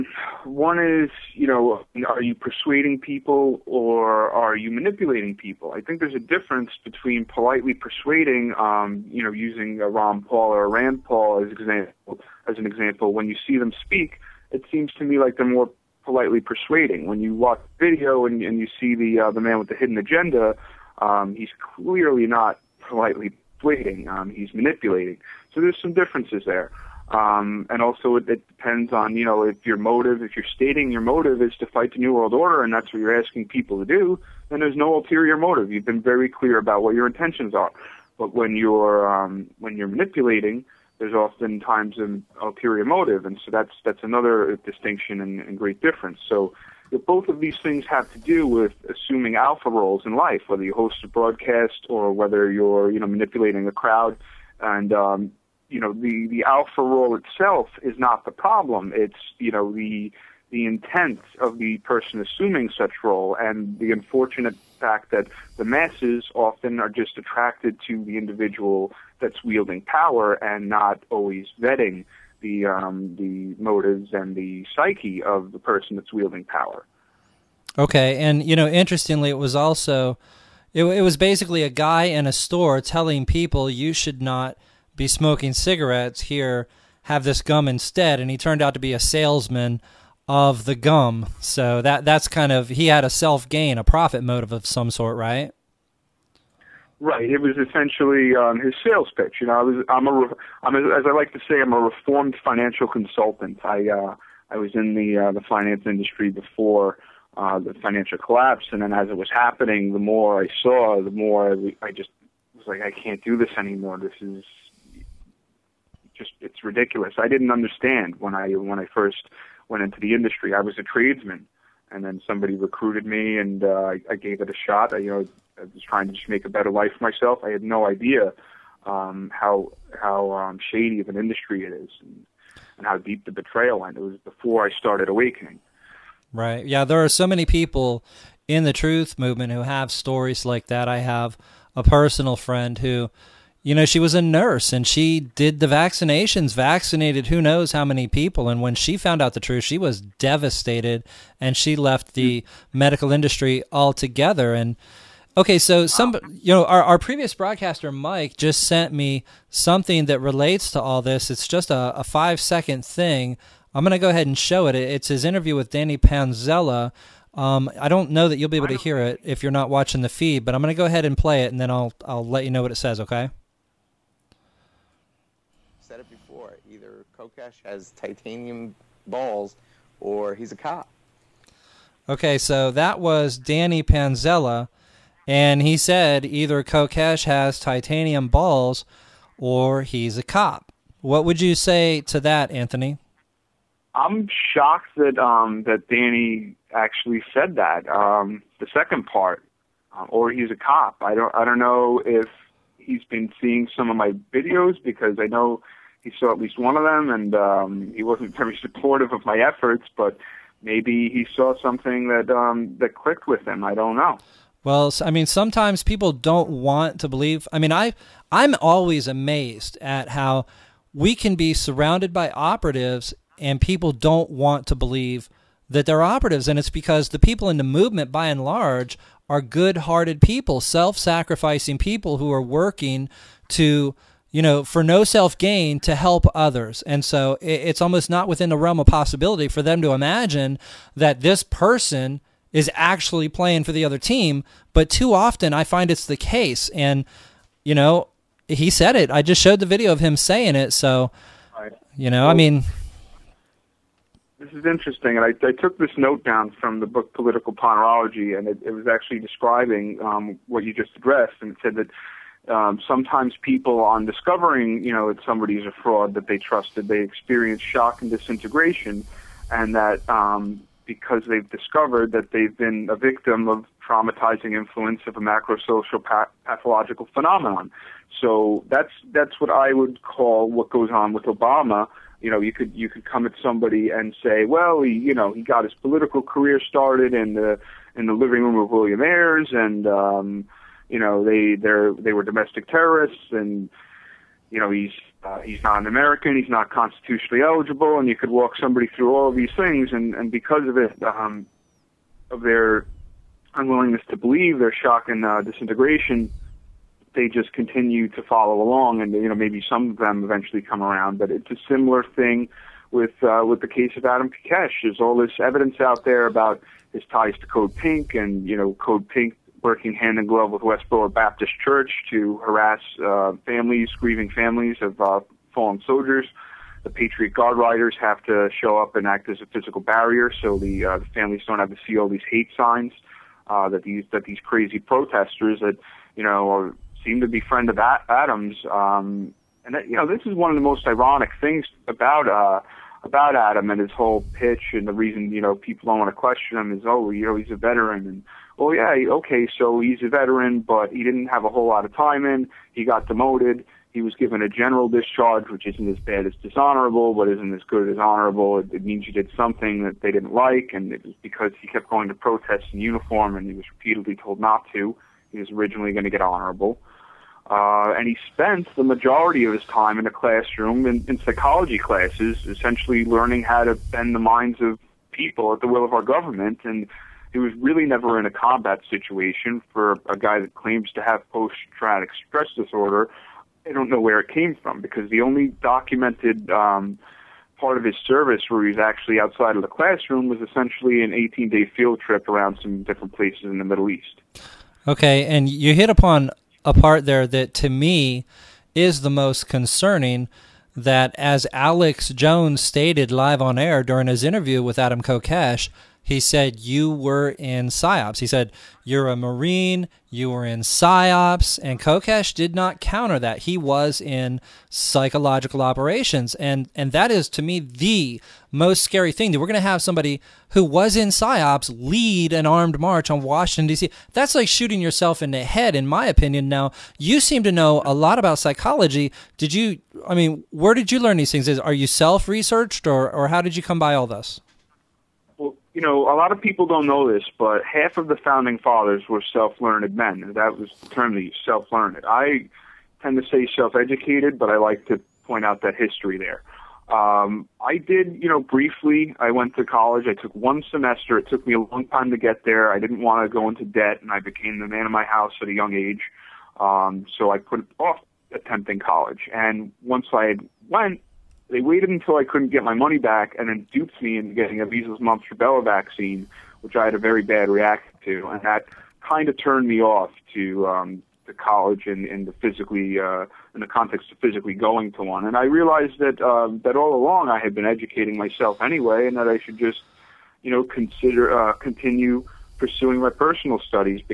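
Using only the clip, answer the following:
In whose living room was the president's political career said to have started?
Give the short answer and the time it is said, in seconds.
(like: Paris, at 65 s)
William Ayers, at 288 s.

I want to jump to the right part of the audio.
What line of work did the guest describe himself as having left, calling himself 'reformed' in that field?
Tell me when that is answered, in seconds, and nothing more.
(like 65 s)
102 s.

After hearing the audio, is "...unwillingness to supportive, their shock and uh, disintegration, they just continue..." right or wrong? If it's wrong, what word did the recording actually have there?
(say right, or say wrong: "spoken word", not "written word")
wrong: "believe", not "supportive".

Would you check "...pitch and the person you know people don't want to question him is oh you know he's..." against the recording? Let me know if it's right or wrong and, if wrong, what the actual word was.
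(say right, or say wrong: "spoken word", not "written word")
wrong: "reason", not "person".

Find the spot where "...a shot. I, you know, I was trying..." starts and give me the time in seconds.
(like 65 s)
124 s.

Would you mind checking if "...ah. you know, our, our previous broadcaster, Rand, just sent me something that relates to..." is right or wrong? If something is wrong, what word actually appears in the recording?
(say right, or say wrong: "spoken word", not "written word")
wrong: "Mike", not "Rand".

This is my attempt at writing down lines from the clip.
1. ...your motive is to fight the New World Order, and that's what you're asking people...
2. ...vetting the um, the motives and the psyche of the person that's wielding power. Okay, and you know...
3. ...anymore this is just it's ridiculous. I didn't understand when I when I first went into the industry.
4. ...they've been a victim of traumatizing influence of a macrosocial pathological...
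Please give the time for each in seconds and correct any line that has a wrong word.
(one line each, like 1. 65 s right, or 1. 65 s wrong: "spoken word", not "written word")
1. 30 s right
2. 71 s right
3. 113 s right
4. 272 s right.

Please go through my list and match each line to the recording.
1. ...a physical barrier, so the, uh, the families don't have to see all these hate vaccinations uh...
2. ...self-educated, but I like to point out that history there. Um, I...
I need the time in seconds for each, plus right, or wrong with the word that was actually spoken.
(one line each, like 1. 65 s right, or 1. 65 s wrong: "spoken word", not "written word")
1. 329 s wrong: "signs", not "vaccinations"
2. 443 s right.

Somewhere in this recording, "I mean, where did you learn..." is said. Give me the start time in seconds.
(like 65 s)
430 s.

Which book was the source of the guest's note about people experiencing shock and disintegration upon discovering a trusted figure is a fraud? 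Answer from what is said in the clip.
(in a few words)
Political Ponerology.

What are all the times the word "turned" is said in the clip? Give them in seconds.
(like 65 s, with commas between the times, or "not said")
88 s, 469 s.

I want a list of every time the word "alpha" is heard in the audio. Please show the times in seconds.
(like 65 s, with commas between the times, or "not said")
49 s, 56 s.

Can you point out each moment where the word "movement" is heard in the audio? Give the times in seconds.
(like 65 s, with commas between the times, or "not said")
139 s, 227 s.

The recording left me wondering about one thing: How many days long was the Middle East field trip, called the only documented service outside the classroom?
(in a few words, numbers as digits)
18.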